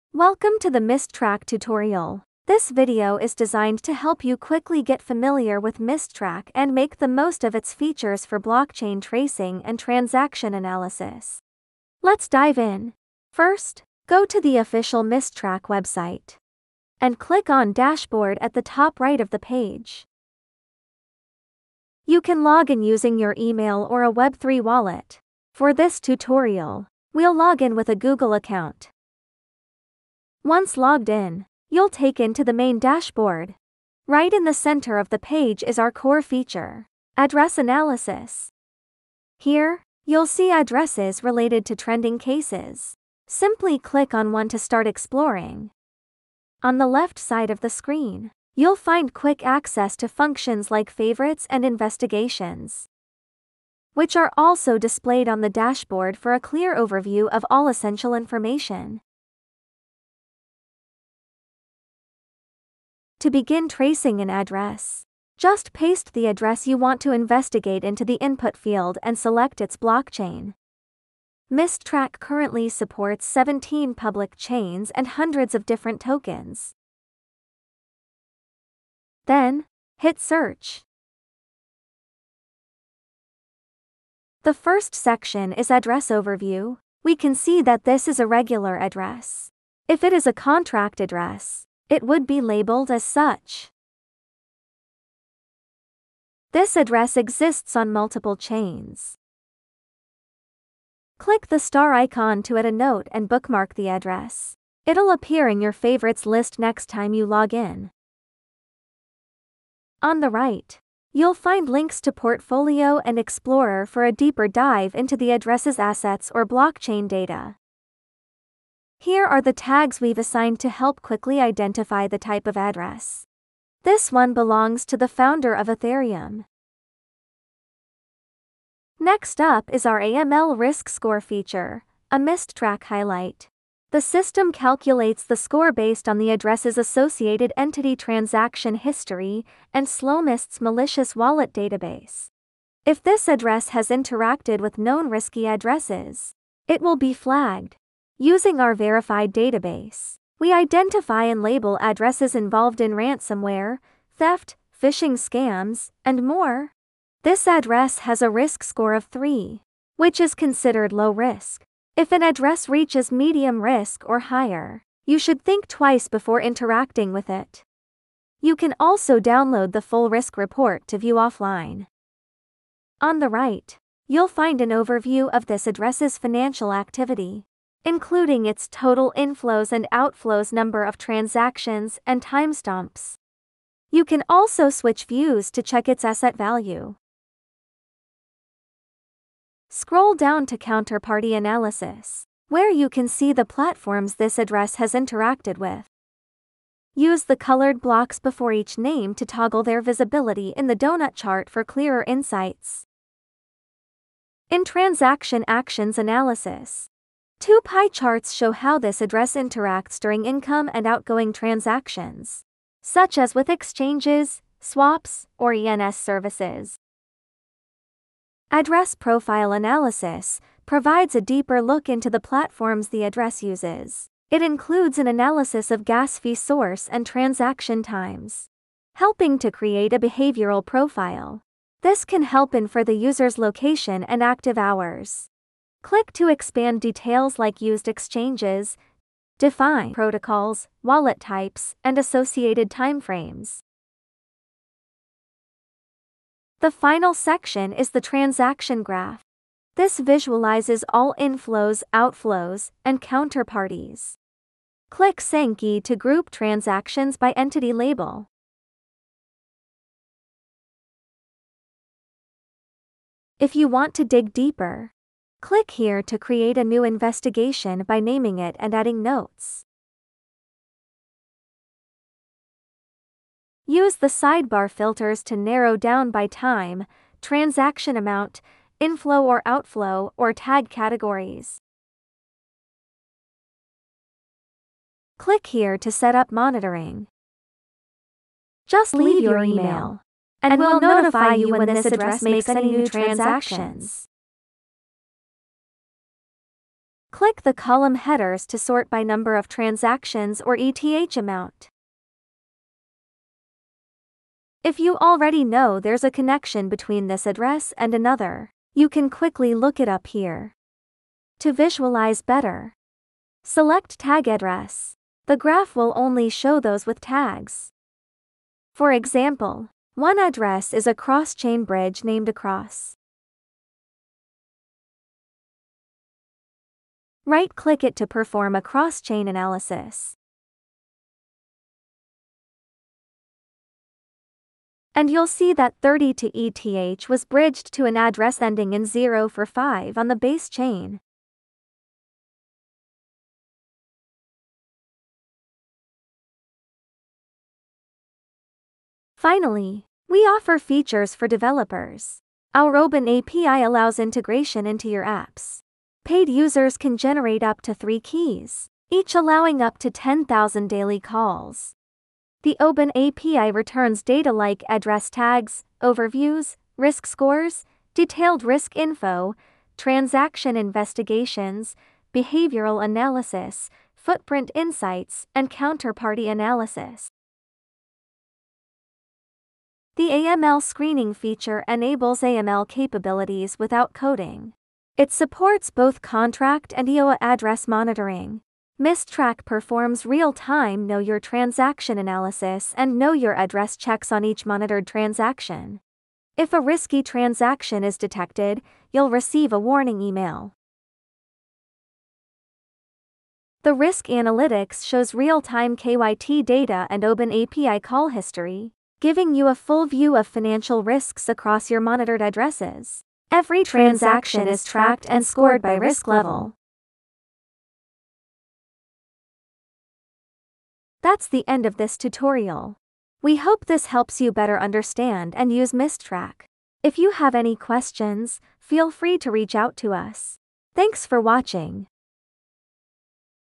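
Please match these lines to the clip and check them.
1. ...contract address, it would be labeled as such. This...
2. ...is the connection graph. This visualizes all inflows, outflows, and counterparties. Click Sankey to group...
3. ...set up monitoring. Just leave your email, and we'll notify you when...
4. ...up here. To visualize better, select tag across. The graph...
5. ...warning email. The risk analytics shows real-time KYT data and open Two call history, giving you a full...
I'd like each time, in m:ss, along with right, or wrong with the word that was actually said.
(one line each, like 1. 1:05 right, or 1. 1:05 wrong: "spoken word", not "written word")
1. 1:30 right
2. 4:07 wrong: "transaction", not "connection"
3. 4:45 right
4. 5:09 wrong: "address", not "across"
5. 6:39 wrong: "API", not "Two".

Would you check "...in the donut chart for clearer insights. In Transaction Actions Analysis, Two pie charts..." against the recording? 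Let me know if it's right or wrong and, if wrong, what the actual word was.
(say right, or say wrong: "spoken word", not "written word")
right.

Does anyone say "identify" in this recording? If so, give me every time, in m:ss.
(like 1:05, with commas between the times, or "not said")
2:01, 2:30.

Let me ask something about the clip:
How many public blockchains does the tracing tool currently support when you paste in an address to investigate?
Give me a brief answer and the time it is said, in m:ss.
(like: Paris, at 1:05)
17, at 1:13.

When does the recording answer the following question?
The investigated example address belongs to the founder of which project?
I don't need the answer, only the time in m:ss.
2:05.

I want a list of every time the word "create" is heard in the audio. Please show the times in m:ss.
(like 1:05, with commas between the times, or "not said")
3:49, 4:26.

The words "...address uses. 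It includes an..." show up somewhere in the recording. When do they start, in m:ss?
3:43.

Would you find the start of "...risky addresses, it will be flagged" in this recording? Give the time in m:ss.
2:25.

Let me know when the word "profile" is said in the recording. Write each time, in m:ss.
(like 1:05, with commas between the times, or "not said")
3:38, 3:50.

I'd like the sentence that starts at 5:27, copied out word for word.
Right-click it to perform a cross-chain analysis.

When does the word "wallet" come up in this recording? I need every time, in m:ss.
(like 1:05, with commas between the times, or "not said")
0:24, 2:21, 4:00.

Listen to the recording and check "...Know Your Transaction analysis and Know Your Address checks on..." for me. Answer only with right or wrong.
right.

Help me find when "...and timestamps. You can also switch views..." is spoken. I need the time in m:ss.
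3:02.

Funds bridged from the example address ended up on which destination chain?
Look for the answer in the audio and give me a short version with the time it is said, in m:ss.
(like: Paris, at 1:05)
Base, at 5:40.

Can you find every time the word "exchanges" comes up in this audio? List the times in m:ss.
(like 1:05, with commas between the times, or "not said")
3:33, 3:57.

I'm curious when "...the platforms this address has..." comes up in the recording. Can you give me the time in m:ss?
3:13.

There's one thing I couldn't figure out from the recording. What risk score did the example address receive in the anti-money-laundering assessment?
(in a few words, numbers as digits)
3.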